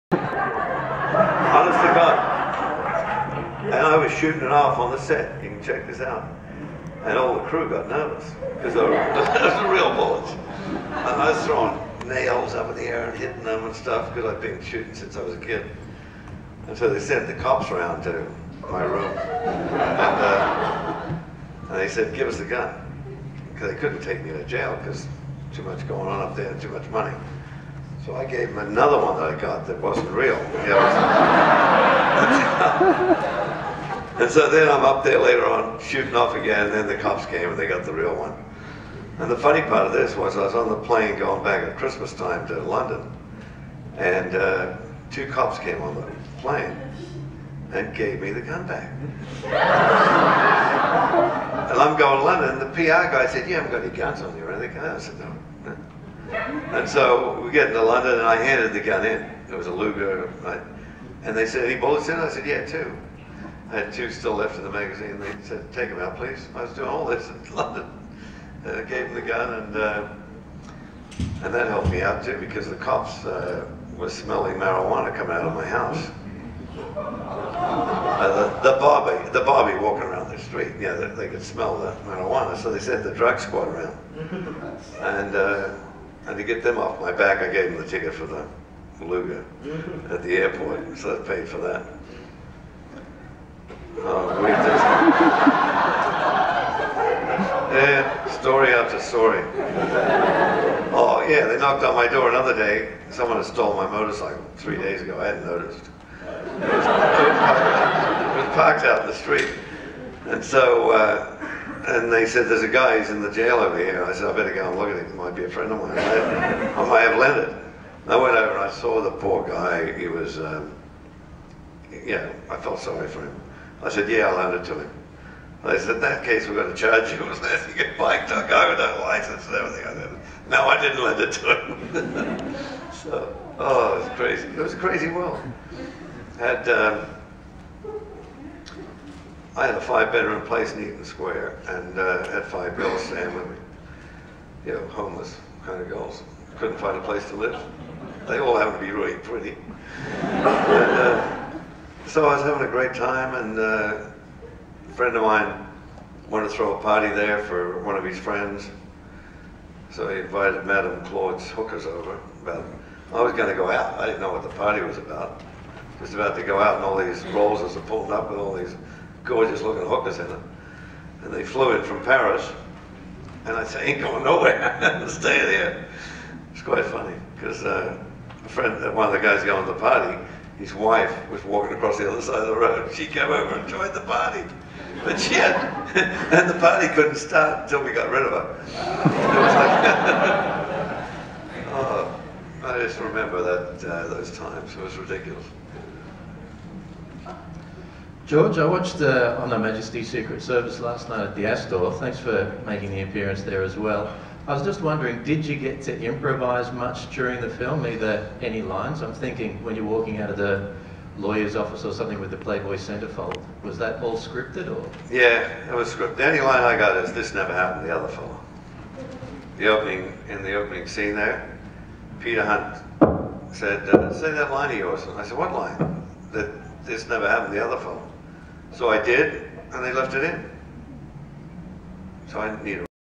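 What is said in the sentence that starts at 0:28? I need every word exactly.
So I gave him another one that I got that wasn't real.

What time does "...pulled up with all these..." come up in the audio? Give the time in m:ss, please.
2:47.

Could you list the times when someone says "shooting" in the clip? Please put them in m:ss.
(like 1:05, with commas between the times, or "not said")
0:04, 0:14, 0:35.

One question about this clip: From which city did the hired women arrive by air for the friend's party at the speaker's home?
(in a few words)
Paris.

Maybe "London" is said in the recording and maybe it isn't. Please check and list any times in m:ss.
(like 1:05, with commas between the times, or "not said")
0:42, 0:52, 0:57, 1:07.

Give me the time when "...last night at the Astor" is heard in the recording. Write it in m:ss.
3:20.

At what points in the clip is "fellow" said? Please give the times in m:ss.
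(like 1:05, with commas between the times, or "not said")
3:38, 3:47.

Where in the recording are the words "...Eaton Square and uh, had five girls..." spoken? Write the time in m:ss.
2:20.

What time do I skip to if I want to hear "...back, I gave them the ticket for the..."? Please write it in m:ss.
1:27.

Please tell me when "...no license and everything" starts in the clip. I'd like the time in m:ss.
2:08.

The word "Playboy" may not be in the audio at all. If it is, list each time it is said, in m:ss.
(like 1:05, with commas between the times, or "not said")
3:32.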